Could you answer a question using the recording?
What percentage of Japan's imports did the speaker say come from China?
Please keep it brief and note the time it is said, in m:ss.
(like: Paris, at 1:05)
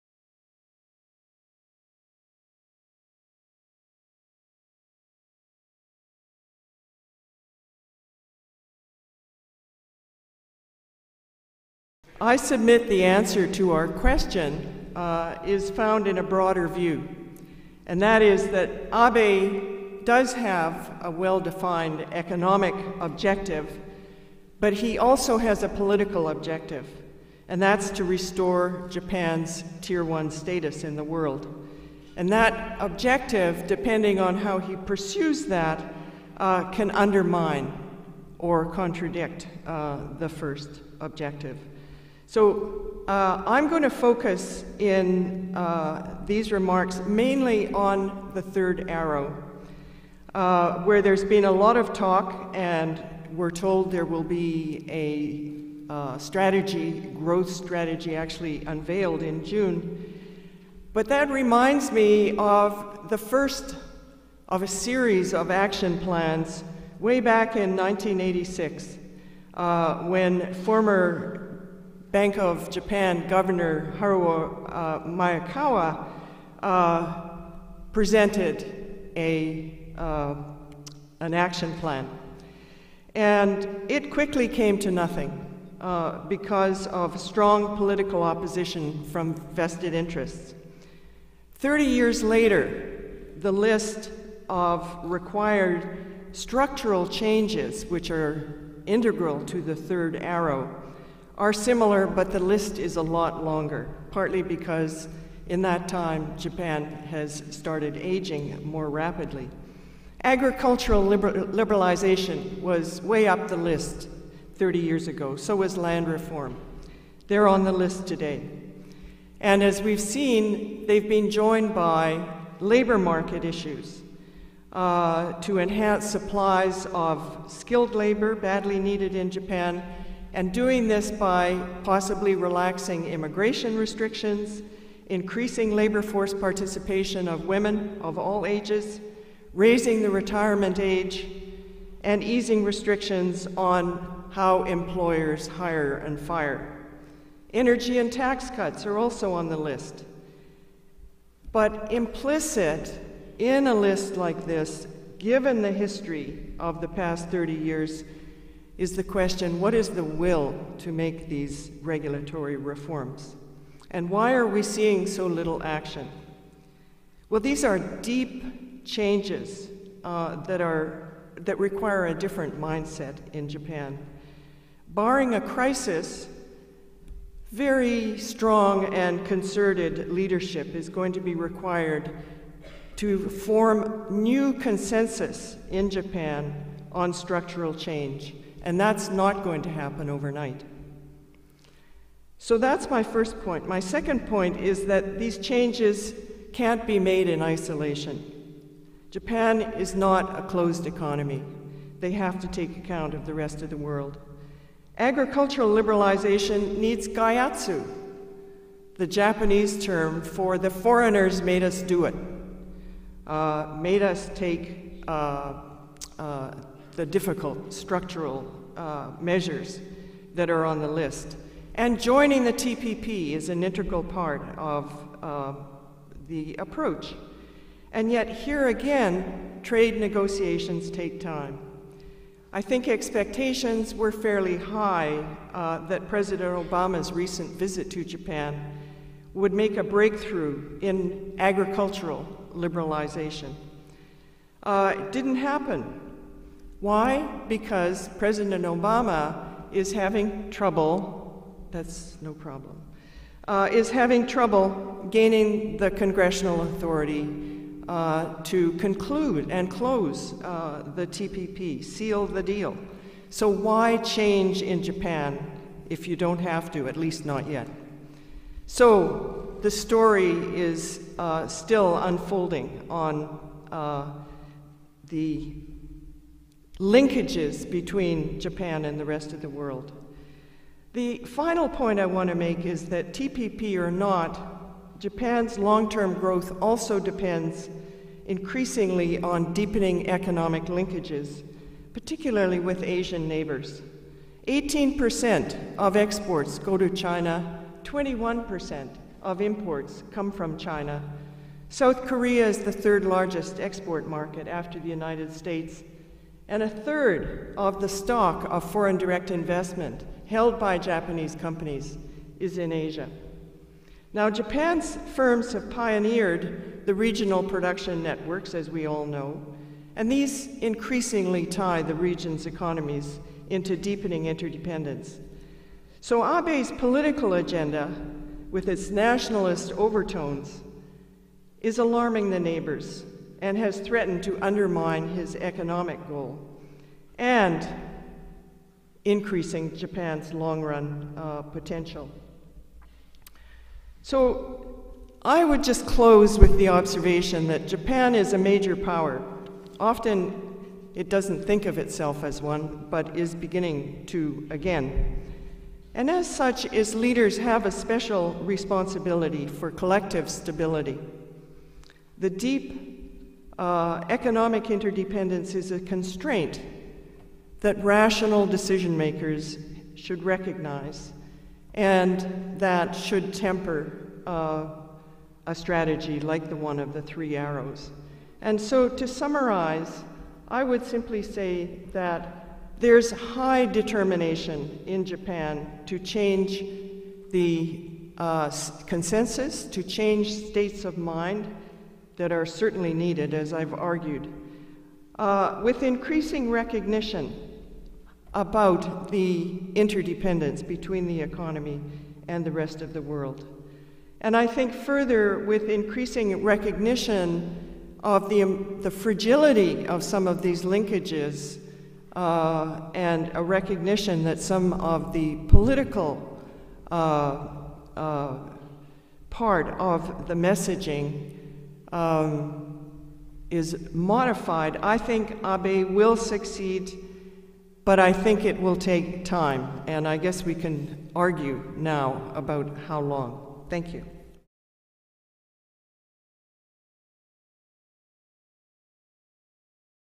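21%, at 4:57.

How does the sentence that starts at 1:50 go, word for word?
Agricultural liberalization was way up the list 30 years ago, so was land reform.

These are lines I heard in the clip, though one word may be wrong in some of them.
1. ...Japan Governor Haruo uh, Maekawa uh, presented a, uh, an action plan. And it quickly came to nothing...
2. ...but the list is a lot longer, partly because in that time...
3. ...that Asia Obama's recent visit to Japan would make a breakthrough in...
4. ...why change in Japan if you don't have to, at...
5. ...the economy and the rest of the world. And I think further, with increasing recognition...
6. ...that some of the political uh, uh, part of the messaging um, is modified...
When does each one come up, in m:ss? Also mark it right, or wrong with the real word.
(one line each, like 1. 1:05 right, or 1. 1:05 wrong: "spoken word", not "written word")
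1. 1:12 right
2. 1:42 right
3. 3:55 wrong: "President", not "Asia"
4. 4:23 right
5. 6:41 right
6. 6:54 right.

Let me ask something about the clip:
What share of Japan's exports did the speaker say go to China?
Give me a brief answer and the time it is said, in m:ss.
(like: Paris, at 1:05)
18%, at 4:54.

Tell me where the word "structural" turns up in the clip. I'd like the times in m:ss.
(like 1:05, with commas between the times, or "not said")
1:36, 3:07, 3:37.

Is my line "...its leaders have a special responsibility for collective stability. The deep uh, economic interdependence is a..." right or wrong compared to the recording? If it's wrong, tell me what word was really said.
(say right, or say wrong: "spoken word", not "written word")
right.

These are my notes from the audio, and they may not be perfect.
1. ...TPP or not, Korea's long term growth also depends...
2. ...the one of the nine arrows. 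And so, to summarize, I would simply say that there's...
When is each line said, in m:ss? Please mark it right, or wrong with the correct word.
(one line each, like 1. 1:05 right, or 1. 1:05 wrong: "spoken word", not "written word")
1. 4:43 wrong: "Japan", not "Korea"
2. 6:16 wrong: "three", not "nine".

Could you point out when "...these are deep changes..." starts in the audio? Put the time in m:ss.
2:47.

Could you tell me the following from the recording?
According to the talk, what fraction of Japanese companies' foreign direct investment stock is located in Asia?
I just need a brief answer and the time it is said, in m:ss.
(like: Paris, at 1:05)
A third, at 5:06.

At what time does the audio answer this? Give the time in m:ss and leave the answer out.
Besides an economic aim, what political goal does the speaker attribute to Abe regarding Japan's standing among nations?
0:28.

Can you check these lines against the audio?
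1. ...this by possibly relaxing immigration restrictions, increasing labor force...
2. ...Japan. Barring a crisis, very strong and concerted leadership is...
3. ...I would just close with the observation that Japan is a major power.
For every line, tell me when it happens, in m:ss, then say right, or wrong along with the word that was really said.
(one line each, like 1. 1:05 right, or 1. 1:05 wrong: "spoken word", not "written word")
1. 2:10 right
2. 2:53 right
3. 5:45 right.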